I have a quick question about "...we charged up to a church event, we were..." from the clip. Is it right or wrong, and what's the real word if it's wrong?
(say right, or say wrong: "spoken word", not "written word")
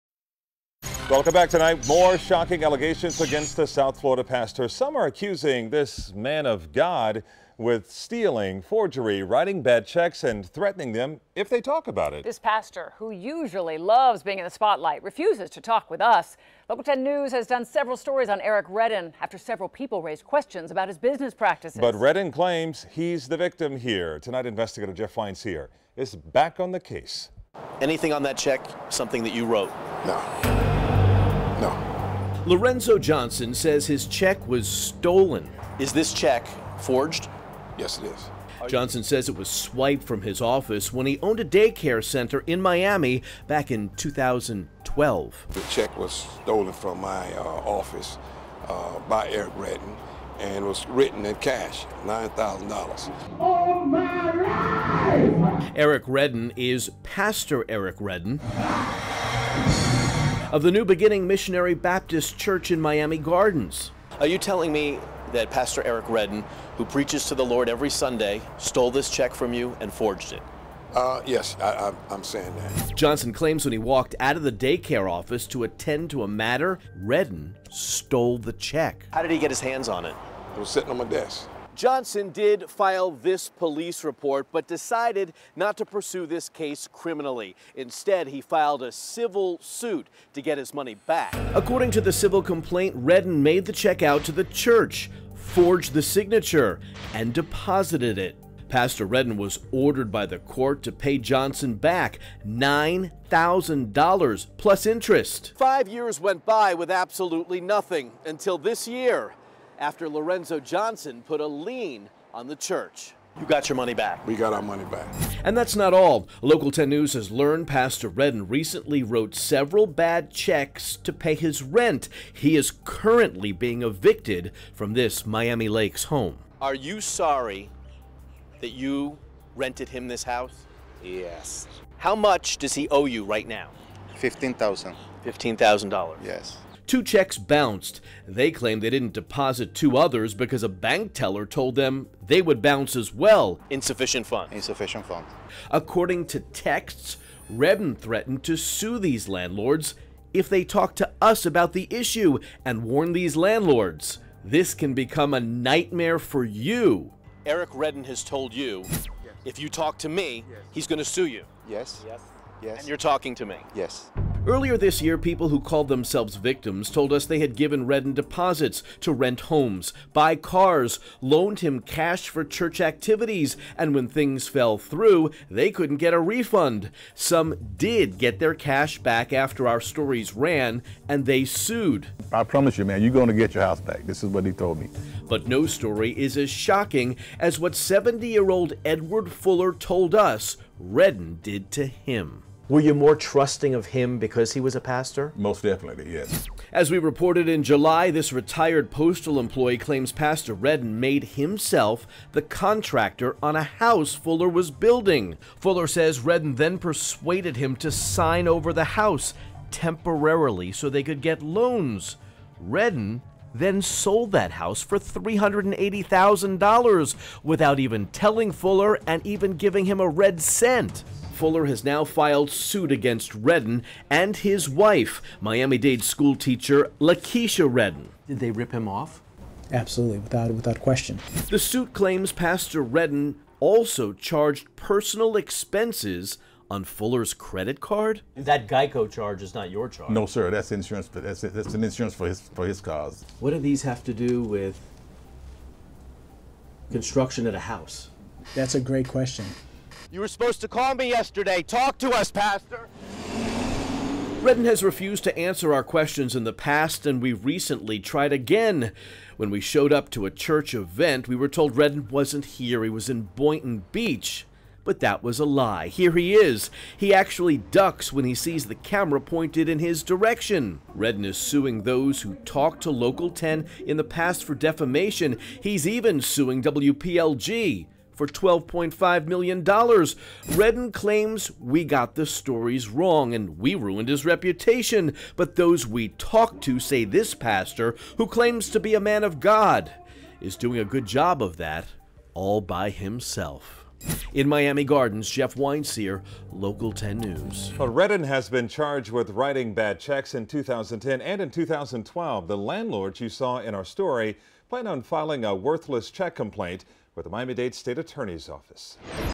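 wrong: "showed", not "charged".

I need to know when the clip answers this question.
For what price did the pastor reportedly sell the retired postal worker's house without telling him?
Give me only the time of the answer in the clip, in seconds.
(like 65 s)
214 s.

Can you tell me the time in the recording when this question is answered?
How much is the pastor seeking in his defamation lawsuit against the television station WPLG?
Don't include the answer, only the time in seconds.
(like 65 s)
278 s.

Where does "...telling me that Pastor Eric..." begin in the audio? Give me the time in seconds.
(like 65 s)
64 s.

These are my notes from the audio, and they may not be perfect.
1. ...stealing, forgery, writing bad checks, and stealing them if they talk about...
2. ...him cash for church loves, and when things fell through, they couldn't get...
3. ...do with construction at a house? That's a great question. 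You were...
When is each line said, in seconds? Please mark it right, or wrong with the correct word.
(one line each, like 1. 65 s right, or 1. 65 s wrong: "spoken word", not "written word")
1. 7 s wrong: "threatening", not "stealing"
2. 171 s wrong: "activities", not "loves"
3. 244 s right.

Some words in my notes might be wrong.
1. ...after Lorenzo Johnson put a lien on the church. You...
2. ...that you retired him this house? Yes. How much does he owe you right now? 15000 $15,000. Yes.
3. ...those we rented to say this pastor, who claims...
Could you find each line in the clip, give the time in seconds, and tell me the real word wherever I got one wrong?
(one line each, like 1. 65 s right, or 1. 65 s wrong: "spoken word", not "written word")
1. 109 s right
2. 128 s wrong: "rented", not "retired"
3. 285 s wrong: "talked", not "rented".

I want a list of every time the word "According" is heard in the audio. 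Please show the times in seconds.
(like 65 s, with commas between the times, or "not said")
91 s, 145 s.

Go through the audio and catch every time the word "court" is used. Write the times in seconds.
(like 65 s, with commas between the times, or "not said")
100 s.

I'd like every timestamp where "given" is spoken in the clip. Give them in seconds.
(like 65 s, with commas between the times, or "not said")
167 s.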